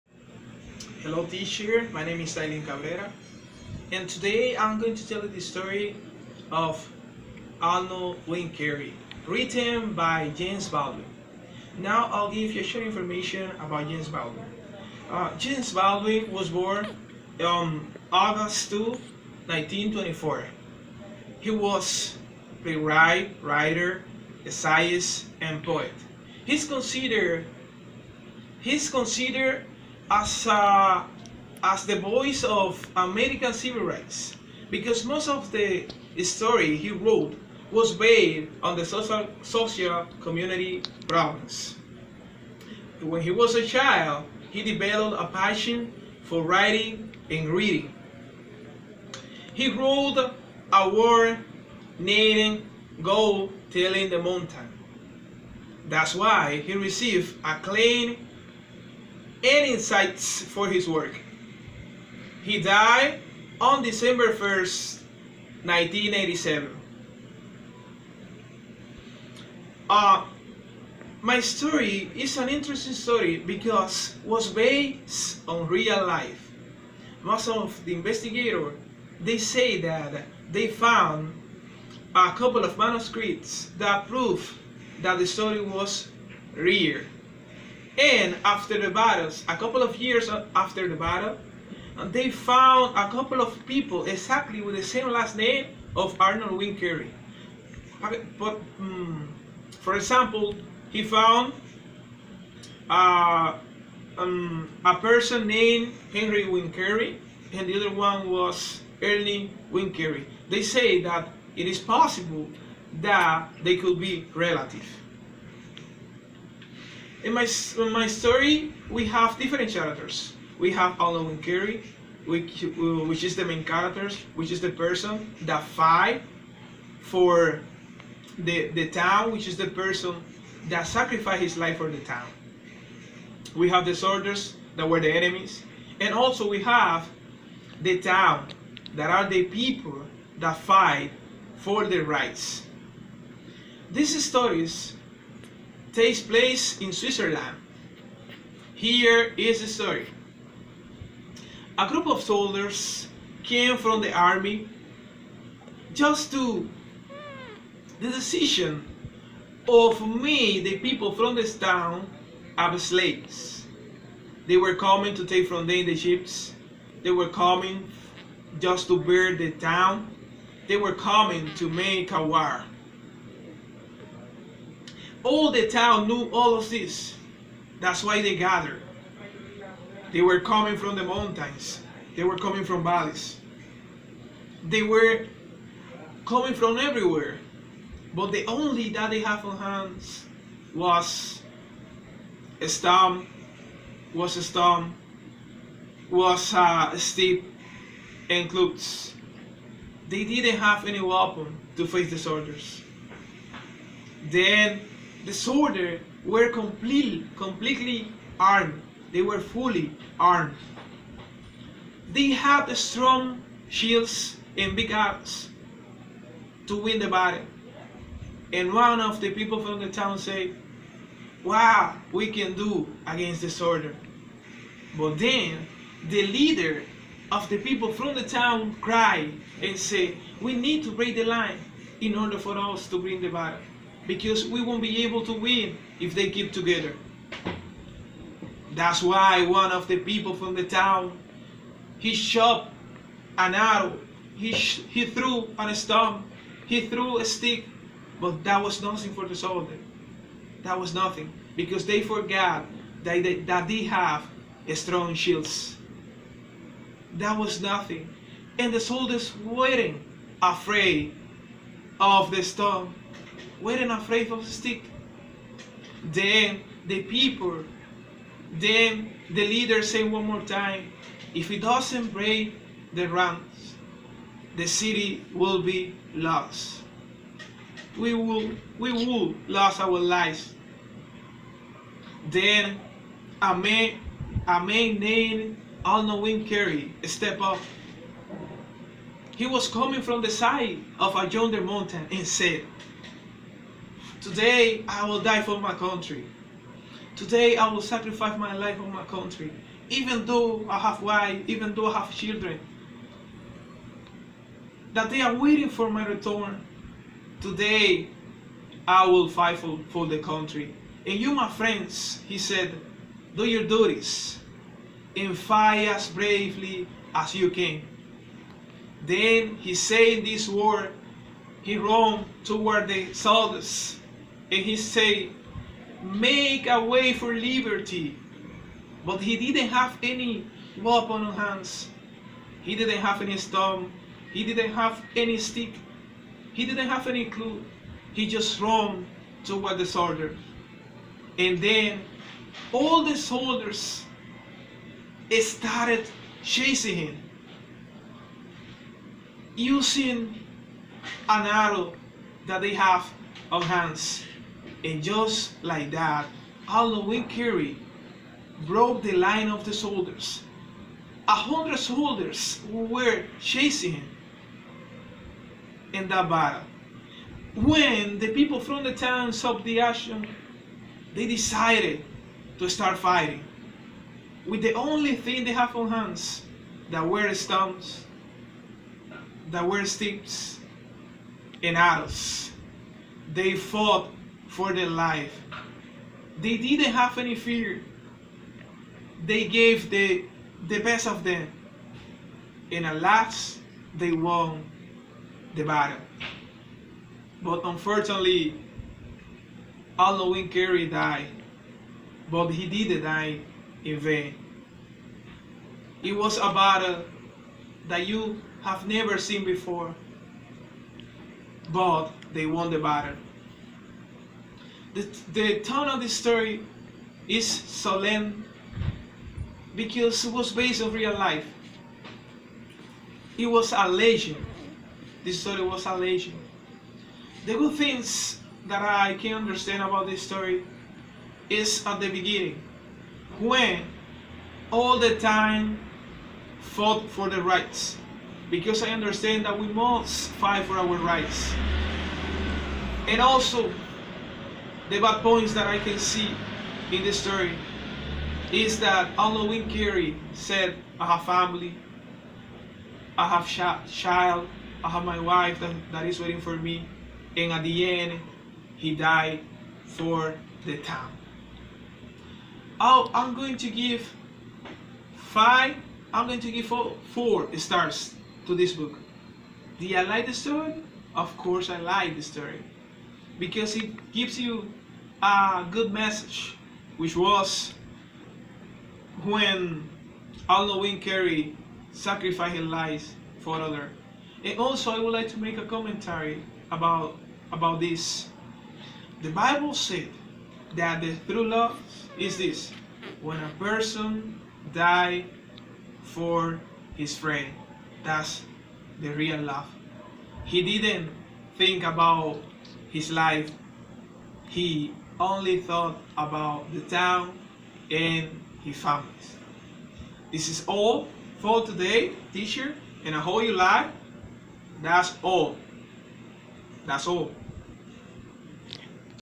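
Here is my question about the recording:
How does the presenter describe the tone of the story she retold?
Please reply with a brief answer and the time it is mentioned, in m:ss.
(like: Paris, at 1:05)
solemn, at 6:57.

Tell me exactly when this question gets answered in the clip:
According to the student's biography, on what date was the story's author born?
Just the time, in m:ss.
0:18.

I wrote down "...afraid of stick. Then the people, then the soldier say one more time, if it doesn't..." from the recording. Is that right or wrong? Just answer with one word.
wrong.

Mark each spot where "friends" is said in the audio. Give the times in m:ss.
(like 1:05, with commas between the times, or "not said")
5:11, 8:17.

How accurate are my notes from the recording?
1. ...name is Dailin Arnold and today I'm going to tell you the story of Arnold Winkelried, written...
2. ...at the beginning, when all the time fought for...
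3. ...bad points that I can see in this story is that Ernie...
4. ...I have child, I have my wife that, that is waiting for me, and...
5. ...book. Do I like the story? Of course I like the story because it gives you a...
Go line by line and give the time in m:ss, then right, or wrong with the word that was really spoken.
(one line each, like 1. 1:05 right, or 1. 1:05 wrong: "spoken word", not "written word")
1. 0:02 wrong: "Cabrera", not "Arnold"
2. 7:11 right
3. 7:24 wrong: "Halloween", not "Ernie"
4. 7:33 right
5. 7:48 right.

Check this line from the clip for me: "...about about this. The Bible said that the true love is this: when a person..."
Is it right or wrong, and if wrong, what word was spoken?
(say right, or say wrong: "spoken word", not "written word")
right.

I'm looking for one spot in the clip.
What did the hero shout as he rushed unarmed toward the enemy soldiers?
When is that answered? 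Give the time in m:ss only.
5:26.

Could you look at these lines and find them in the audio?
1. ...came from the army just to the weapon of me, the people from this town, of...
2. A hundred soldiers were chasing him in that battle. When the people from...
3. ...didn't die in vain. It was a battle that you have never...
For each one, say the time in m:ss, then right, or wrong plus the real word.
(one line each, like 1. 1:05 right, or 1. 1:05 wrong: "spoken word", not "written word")
1. 2:33 wrong: "decision", not "weapon"
2. 6:01 right
3. 6:42 right.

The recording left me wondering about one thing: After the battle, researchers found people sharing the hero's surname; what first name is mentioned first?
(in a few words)
Henry.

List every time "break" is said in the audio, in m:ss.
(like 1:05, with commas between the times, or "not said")
3:50, 4:32.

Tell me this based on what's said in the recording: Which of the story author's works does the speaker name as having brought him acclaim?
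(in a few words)
Go Tell It on the Mountain.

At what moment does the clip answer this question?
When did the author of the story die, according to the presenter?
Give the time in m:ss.
1:03.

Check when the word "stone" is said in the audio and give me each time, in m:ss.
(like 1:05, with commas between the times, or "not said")
4:05, 5:33, 6:17.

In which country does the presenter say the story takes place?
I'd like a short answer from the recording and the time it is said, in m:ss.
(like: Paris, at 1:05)
Switzerland, at 2:26.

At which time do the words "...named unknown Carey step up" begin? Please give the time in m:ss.
4:44.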